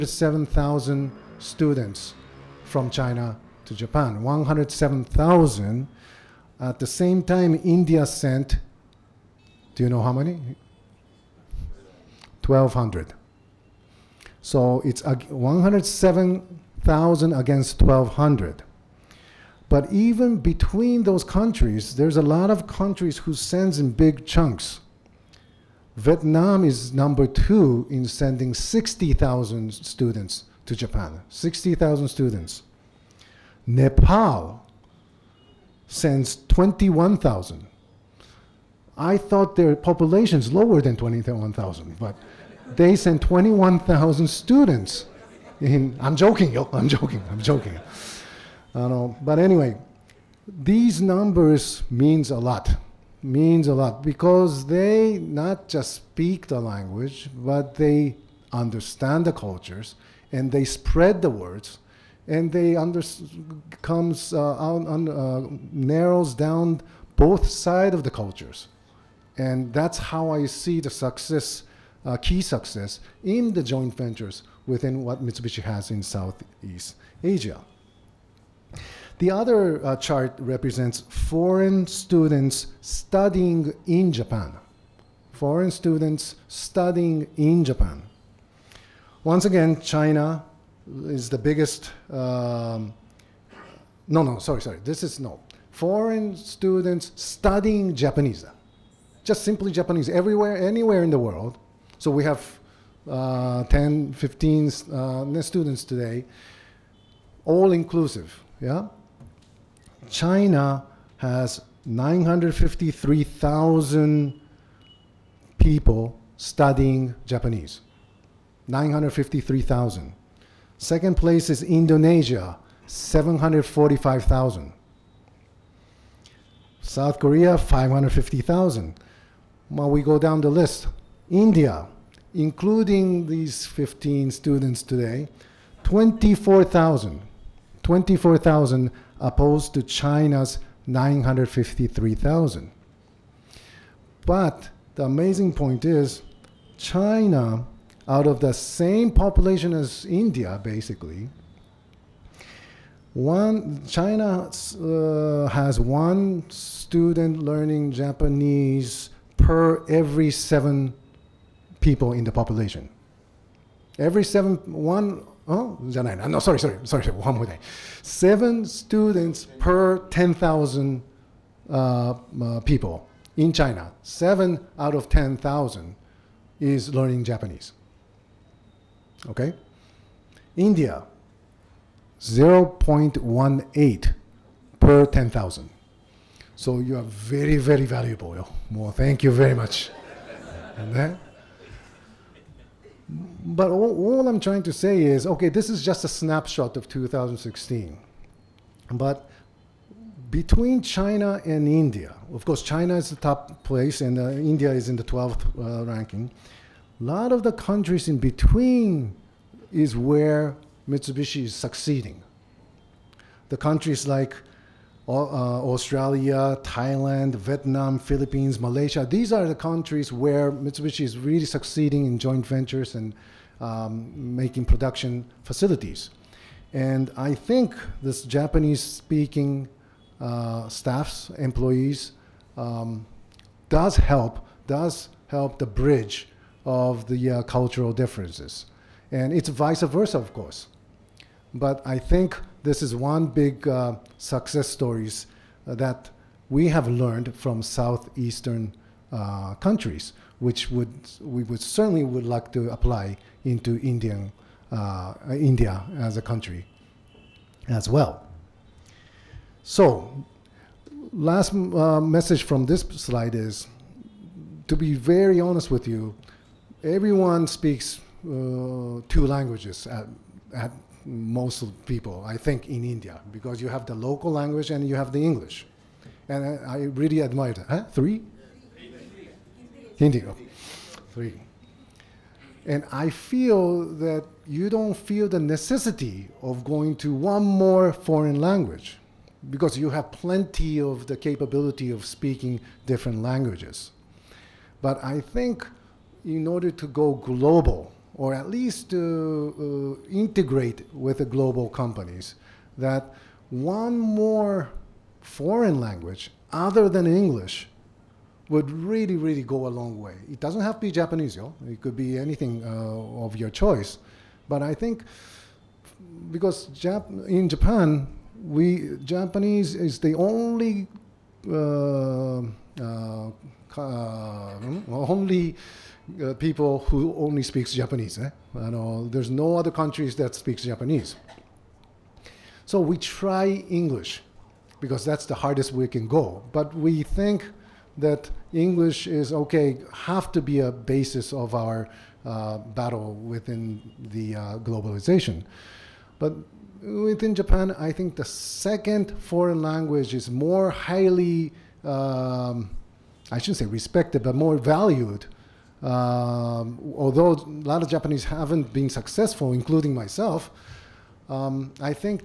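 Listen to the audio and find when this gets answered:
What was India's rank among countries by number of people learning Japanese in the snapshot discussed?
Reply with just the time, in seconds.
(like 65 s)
205 s.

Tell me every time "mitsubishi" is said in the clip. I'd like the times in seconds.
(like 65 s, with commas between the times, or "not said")
75 s, 210 s, 220 s.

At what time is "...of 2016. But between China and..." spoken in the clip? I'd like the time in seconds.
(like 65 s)
196 s.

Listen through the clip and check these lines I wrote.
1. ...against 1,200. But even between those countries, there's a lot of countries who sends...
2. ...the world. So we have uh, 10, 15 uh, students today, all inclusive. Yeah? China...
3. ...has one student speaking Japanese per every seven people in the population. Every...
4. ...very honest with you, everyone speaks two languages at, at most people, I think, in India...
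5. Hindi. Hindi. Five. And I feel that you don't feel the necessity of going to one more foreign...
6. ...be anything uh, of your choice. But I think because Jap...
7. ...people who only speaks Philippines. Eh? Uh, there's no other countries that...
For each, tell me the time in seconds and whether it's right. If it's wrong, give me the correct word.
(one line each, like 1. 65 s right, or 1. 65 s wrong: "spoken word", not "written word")
1. 17 s right
2. 101 s right
3. 155 s wrong: "learning", not "speaking"
4. 264 s right
5. 279 s wrong: "Three", not "Five"
6. 311 s right
7. 326 s wrong: "Japanese", not "Philippines".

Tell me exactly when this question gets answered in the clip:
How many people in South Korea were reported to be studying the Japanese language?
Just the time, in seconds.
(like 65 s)
127 s.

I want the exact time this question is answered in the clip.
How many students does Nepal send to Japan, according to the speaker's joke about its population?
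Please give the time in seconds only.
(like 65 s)
33 s.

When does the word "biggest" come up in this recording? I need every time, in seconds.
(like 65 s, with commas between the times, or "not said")
91 s.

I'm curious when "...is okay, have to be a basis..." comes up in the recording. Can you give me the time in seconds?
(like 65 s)
339 s.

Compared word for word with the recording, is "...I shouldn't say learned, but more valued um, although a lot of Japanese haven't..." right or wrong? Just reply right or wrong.
wrong.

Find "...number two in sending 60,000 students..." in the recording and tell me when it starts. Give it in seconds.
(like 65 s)
26 s.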